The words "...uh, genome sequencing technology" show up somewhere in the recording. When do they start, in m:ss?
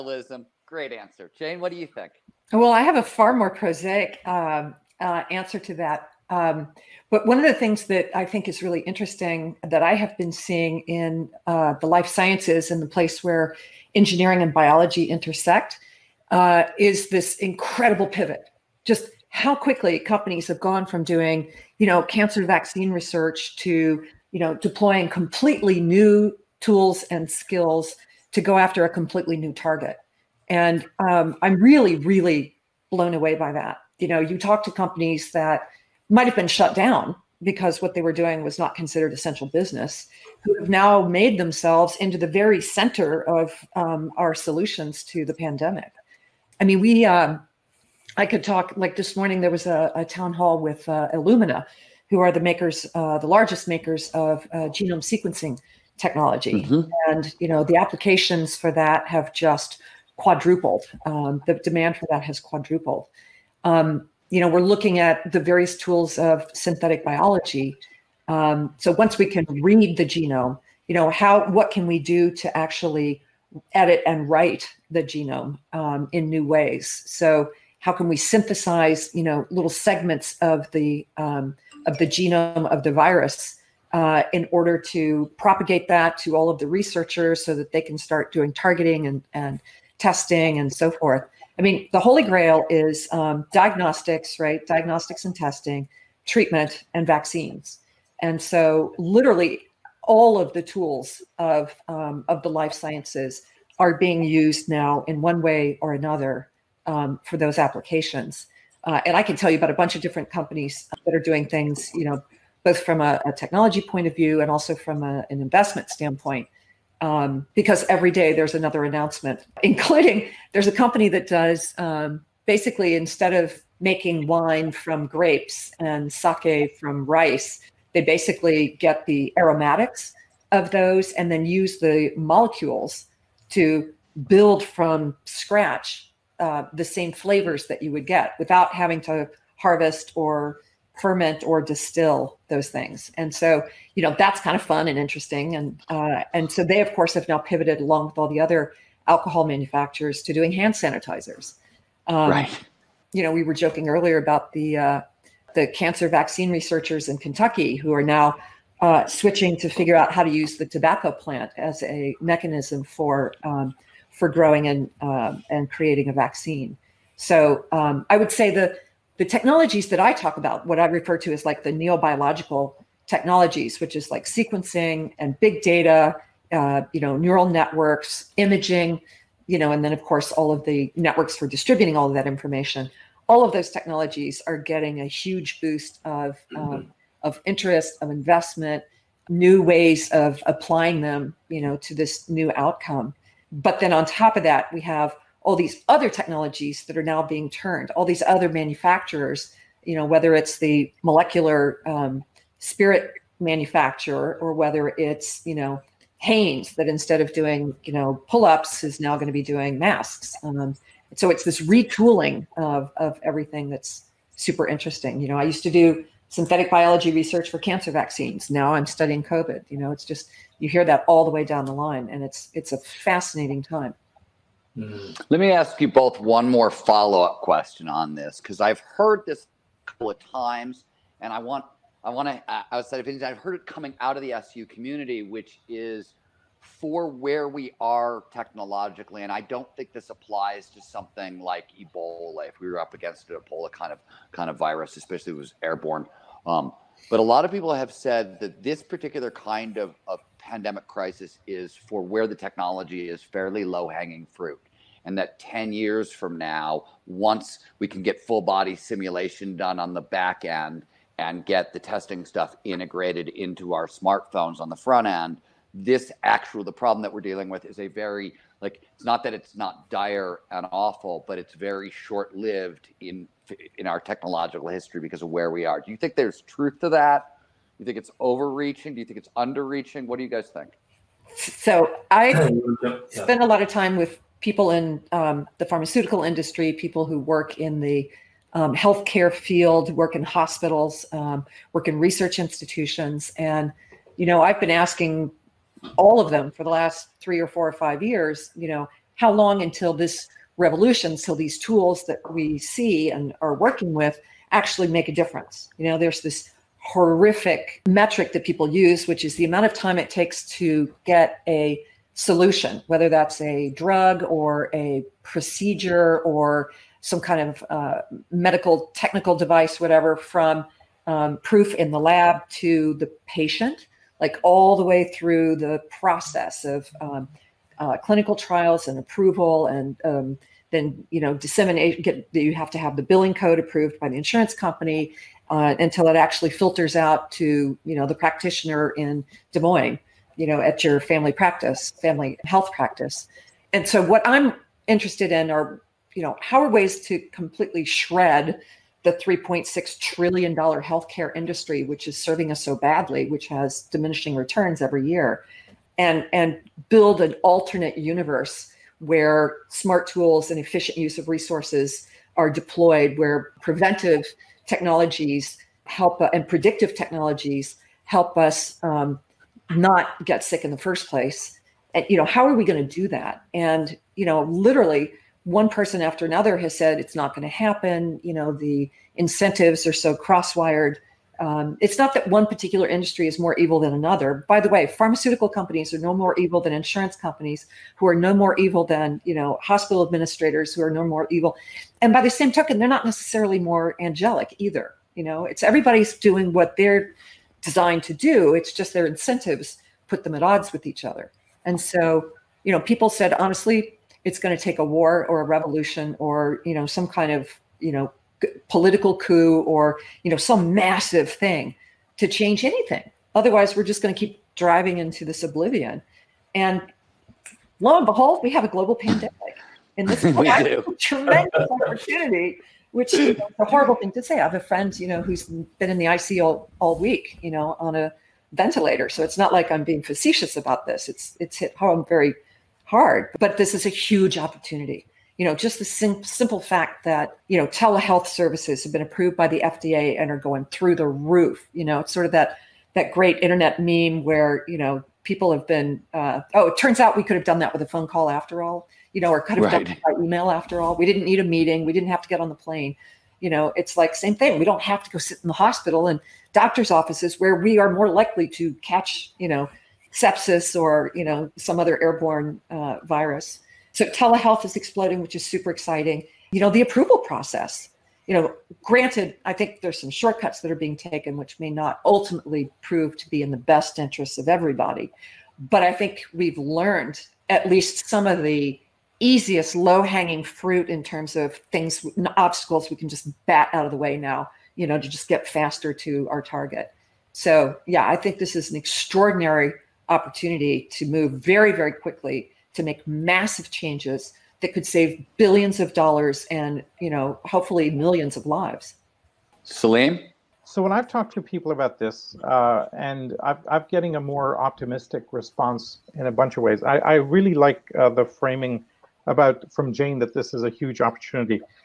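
0:54.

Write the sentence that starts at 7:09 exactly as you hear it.
So it's not like I'm being facetious about this.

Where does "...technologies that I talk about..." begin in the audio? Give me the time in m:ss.
2:49.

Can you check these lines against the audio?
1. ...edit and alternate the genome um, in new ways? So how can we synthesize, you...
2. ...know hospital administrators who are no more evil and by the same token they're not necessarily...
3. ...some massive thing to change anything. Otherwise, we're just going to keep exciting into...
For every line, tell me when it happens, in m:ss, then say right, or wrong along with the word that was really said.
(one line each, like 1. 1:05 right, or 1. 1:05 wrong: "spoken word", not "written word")
1. 1:13 wrong: "write", not "alternate"
2. 6:29 right
3. 6:50 wrong: "driving", not "exciting".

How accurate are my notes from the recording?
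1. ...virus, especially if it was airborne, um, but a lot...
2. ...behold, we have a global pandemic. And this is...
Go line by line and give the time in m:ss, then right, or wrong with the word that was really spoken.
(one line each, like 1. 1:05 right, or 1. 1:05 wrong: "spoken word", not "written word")
1. 4:04 right
2. 6:58 right.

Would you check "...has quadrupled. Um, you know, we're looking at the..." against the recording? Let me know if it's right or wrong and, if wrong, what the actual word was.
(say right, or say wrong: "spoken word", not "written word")
right.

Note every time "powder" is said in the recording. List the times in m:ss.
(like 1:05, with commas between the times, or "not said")
not said.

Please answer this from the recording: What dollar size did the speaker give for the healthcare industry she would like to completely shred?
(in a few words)
$3.6 trillion.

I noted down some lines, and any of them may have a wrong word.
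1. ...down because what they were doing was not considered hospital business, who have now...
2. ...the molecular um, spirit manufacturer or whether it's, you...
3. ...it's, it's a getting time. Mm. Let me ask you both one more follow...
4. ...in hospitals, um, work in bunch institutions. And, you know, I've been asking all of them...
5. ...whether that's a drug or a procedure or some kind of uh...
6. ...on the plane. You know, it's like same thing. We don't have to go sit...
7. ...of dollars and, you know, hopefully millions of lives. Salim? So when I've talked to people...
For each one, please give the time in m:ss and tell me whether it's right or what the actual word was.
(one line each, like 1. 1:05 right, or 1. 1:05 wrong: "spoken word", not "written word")
1. 0:36 wrong: "essential", not "hospital"
2. 3:20 right
3. 3:42 wrong: "fascinating", not "getting"
4. 4:50 wrong: "research", not "bunch"
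5. 5:12 right
6. 7:32 right
7. 8:15 right.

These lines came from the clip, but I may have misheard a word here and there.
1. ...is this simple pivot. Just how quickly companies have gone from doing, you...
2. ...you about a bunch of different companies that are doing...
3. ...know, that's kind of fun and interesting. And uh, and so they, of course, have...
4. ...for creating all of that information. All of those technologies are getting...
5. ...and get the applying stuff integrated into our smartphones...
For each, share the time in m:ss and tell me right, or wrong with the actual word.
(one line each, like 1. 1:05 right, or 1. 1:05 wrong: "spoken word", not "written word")
1. 0:16 wrong: "incredible", not "simple"
2. 1:49 right
3. 2:24 right
4. 3:01 wrong: "distributing", not "creating"
5. 4:21 wrong: "testing", not "applying".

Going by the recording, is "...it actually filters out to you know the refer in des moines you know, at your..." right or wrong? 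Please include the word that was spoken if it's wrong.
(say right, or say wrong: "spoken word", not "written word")
wrong: "practitioner", not "refer".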